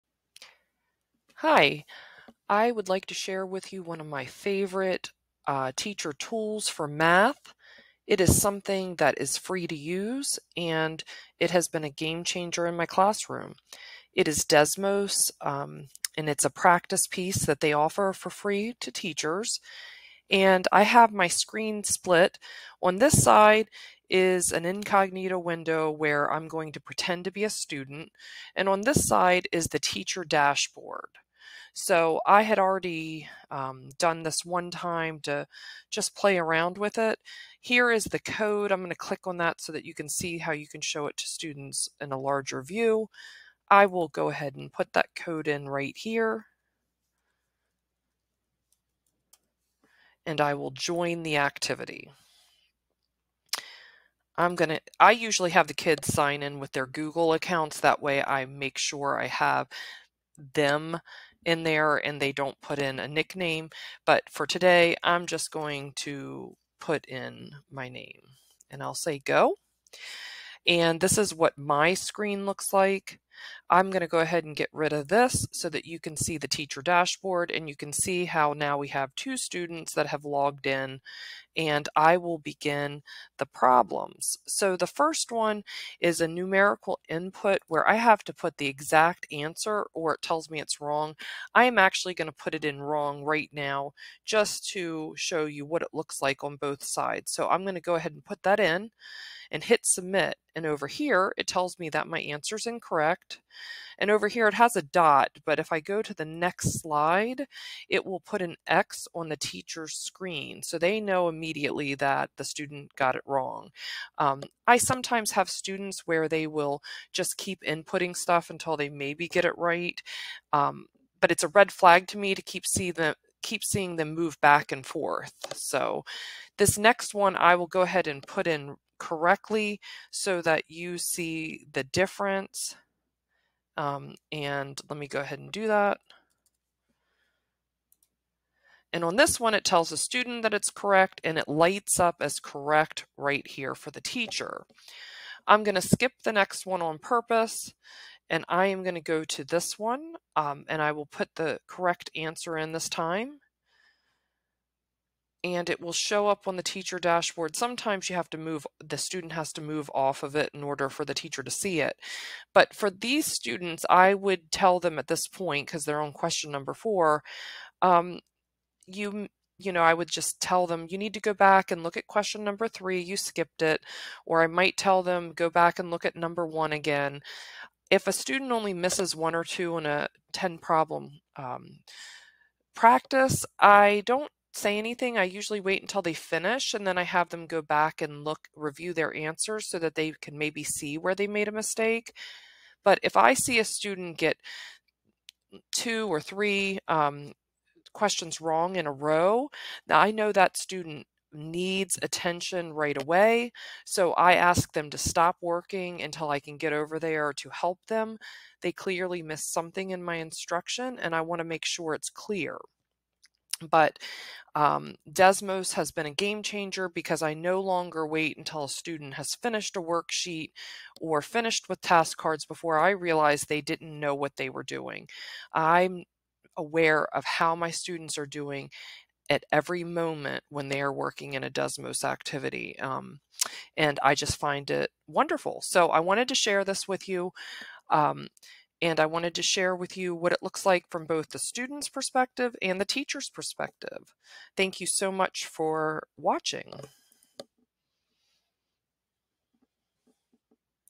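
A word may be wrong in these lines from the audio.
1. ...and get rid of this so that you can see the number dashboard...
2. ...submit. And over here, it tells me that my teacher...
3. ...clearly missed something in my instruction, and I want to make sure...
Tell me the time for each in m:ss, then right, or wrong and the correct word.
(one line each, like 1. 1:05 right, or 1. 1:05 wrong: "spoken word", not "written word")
1. 1:14 wrong: "teacher", not "number"
2. 1:39 wrong: "answer", not "teacher"
3. 3:28 right.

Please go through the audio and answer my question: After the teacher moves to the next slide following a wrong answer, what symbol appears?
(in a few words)
An X.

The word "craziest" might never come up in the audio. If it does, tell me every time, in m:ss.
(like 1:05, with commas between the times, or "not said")
not said.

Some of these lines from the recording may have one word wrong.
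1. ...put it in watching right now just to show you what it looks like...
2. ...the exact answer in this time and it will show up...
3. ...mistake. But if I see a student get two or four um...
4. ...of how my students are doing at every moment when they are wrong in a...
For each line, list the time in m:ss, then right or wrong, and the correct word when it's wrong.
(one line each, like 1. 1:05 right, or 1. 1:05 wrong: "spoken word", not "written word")
1. 1:32 wrong: "wrong", not "watching"
2. 2:31 wrong: "correct", not "exact"
3. 3:11 wrong: "three", not "four"
4. 3:47 wrong: "working", not "wrong".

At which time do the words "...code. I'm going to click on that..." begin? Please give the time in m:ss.
0:38.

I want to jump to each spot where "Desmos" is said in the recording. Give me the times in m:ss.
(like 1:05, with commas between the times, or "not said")
0:14, 3:35, 3:51.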